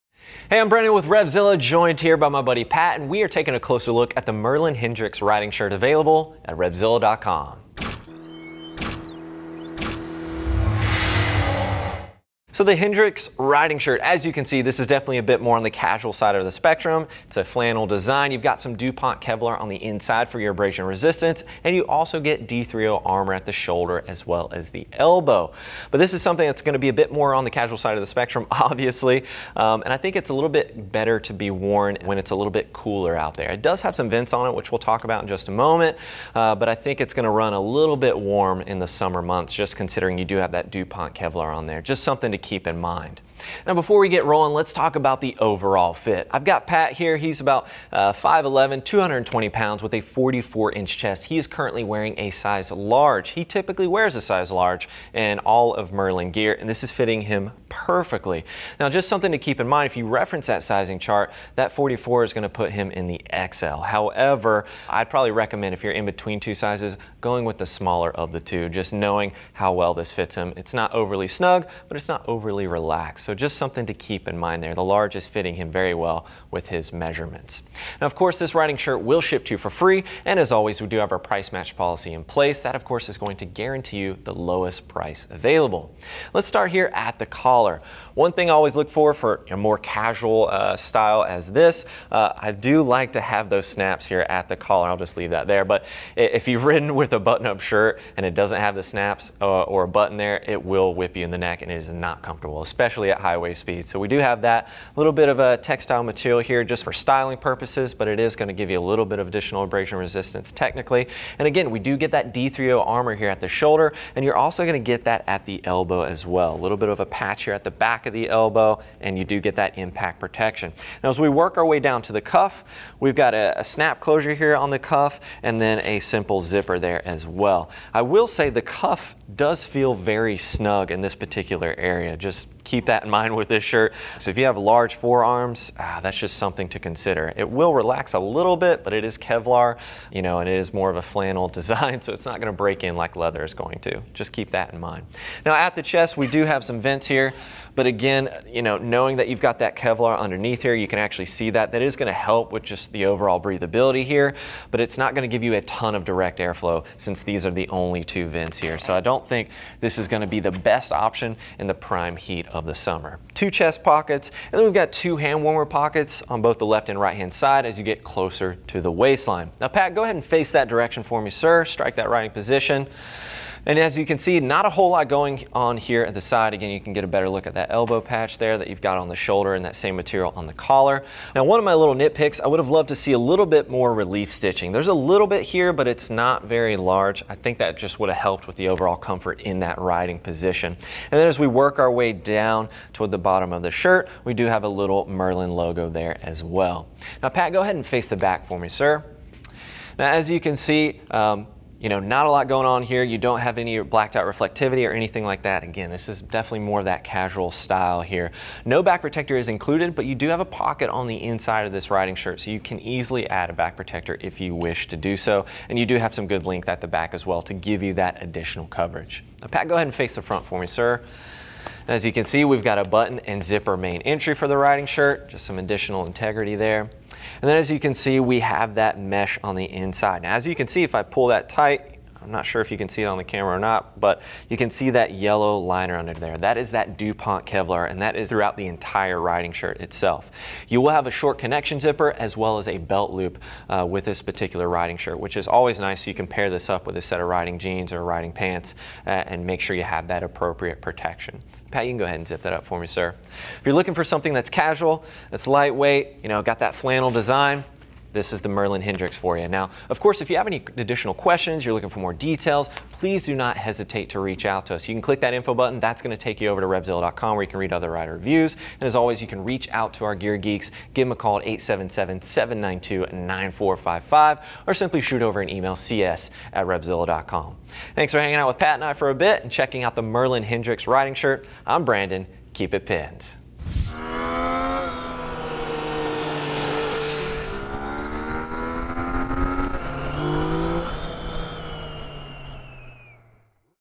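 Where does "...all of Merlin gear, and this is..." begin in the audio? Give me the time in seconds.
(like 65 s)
55 s.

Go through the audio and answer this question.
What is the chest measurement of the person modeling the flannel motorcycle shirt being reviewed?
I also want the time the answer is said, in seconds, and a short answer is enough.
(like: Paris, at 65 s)
44 inches, at 50 s.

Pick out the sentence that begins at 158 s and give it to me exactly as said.
So I don't think this is gonna be the best option in the prime heat of the summer.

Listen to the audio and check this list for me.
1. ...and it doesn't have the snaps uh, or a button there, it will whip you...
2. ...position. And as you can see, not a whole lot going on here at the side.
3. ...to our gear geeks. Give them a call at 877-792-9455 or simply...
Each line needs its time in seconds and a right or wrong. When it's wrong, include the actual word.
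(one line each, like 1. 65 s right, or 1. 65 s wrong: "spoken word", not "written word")
1. 98 s right
2. 172 s right
3. 269 s right.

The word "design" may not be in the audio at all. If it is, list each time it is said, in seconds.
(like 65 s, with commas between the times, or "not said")
17 s, 141 s, 257 s.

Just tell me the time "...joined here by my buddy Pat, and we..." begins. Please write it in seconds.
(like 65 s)
1 s.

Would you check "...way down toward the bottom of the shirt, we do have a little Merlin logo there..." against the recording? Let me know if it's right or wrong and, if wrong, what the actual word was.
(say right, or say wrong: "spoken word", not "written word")
right.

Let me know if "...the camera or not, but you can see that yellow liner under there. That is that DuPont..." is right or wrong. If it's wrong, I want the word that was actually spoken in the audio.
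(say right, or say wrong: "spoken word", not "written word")
right.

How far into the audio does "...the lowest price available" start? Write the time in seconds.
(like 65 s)
84 s.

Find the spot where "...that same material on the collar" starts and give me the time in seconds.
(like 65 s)
179 s.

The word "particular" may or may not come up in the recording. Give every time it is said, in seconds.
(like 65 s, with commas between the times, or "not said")
131 s, 244 s.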